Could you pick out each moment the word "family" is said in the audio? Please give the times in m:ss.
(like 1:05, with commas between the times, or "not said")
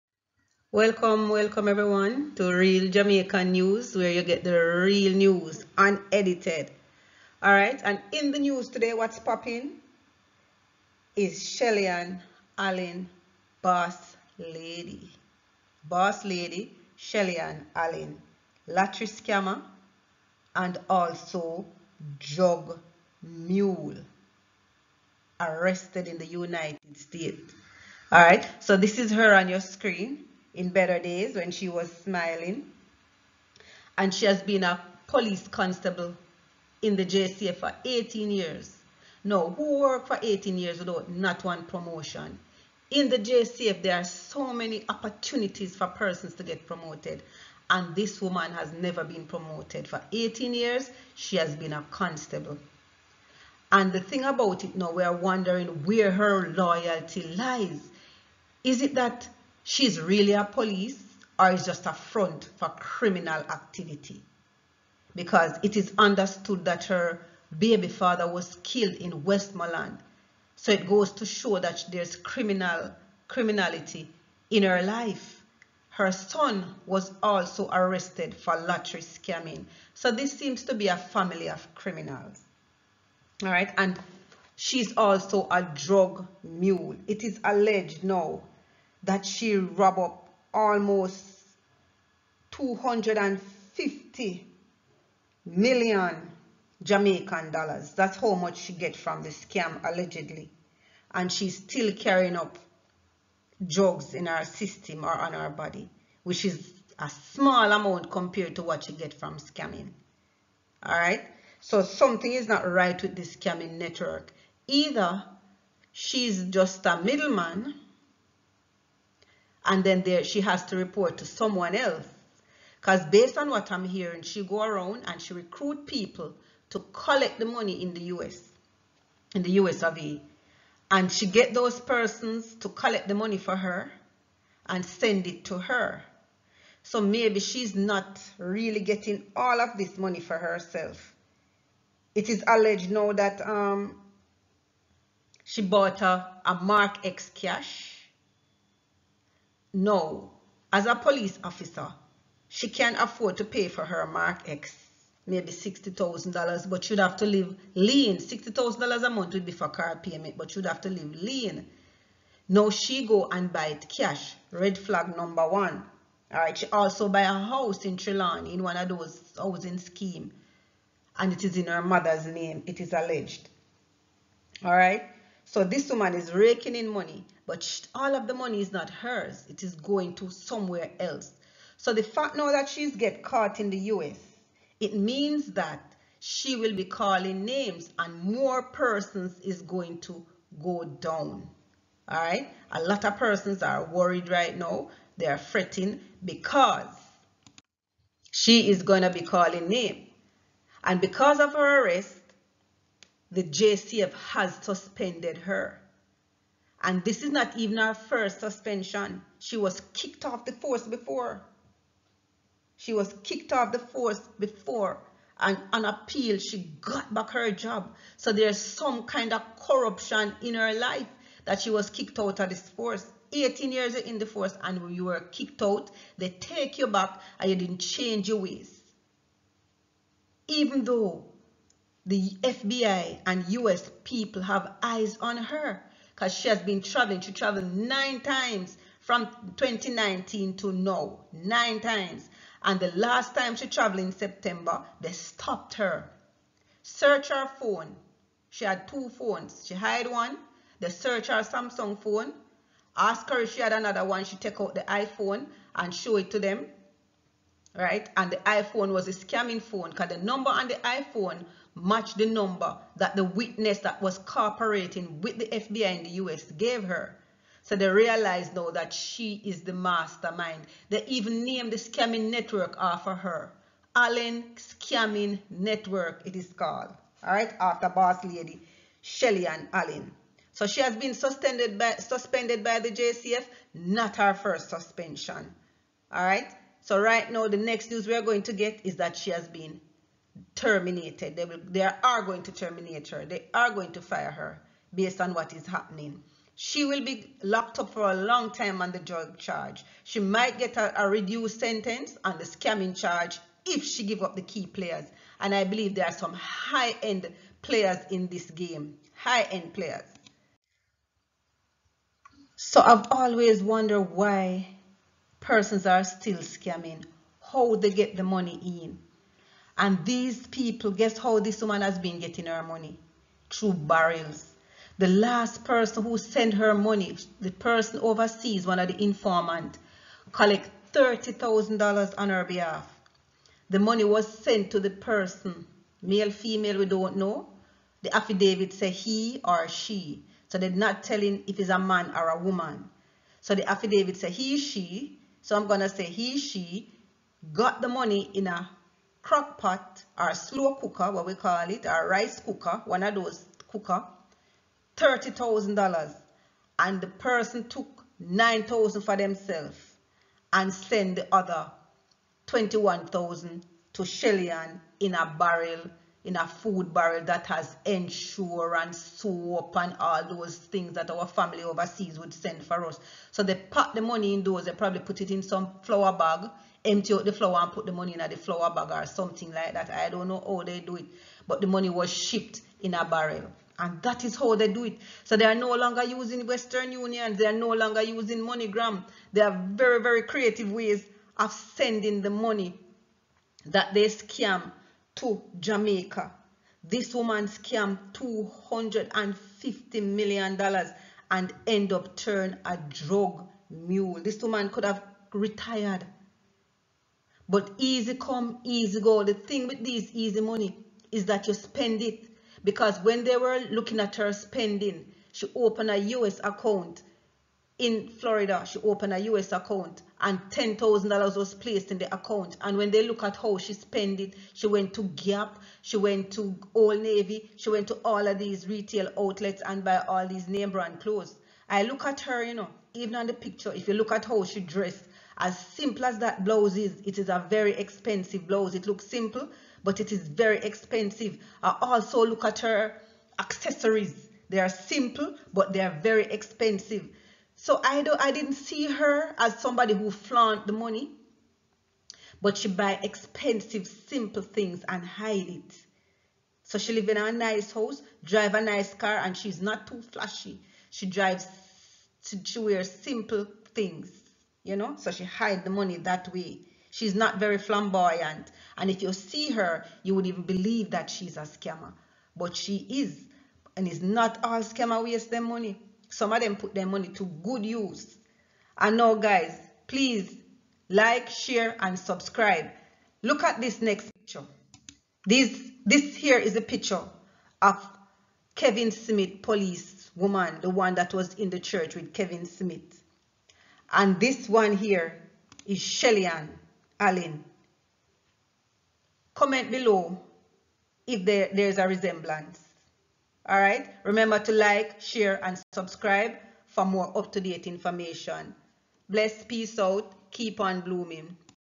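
1:20, 6:11.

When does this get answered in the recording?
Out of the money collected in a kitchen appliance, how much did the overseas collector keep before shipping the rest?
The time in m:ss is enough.
5:58.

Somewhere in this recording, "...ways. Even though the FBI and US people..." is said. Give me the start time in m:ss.
3:48.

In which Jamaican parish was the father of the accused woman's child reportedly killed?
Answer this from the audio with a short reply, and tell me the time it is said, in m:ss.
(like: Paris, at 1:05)
Westmoreland, at 1:09.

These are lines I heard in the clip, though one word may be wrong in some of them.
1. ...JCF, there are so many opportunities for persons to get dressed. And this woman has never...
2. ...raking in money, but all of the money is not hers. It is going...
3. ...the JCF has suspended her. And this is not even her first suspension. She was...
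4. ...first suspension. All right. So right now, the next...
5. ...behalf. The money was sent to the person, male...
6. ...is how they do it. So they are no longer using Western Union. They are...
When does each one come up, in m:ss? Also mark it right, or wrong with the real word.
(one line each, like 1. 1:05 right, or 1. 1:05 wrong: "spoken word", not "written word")
1. 0:43 wrong: "promoted", not "dressed"
2. 2:56 right
3. 3:23 right
4. 4:44 right
5. 5:32 right
6. 6:24 right.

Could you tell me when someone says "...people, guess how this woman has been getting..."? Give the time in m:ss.
5:20.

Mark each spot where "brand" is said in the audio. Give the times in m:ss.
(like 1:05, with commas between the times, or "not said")
7:10.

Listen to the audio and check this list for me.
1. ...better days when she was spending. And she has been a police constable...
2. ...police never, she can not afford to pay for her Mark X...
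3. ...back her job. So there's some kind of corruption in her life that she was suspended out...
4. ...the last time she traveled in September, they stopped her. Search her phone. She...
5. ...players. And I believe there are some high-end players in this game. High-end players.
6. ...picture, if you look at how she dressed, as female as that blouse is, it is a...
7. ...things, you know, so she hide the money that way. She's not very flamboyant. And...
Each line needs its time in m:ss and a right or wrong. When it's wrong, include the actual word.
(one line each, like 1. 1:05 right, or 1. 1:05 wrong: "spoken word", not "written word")
1. 0:30 wrong: "smiling", not "spending"
2. 2:30 wrong: "officer", not "never"
3. 3:37 wrong: "kicked", not "suspended"
4. 4:02 right
5. 5:04 right
6. 7:13 wrong: "simple", not "female"
7. 7:43 right.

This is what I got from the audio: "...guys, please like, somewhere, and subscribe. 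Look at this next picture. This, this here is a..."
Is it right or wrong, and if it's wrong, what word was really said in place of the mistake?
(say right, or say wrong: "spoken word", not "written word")
wrong: "share", not "somewhere".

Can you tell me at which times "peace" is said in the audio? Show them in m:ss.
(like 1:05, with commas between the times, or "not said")
8:29.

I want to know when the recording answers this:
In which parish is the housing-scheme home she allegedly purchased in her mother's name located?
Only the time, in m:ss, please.
2:47.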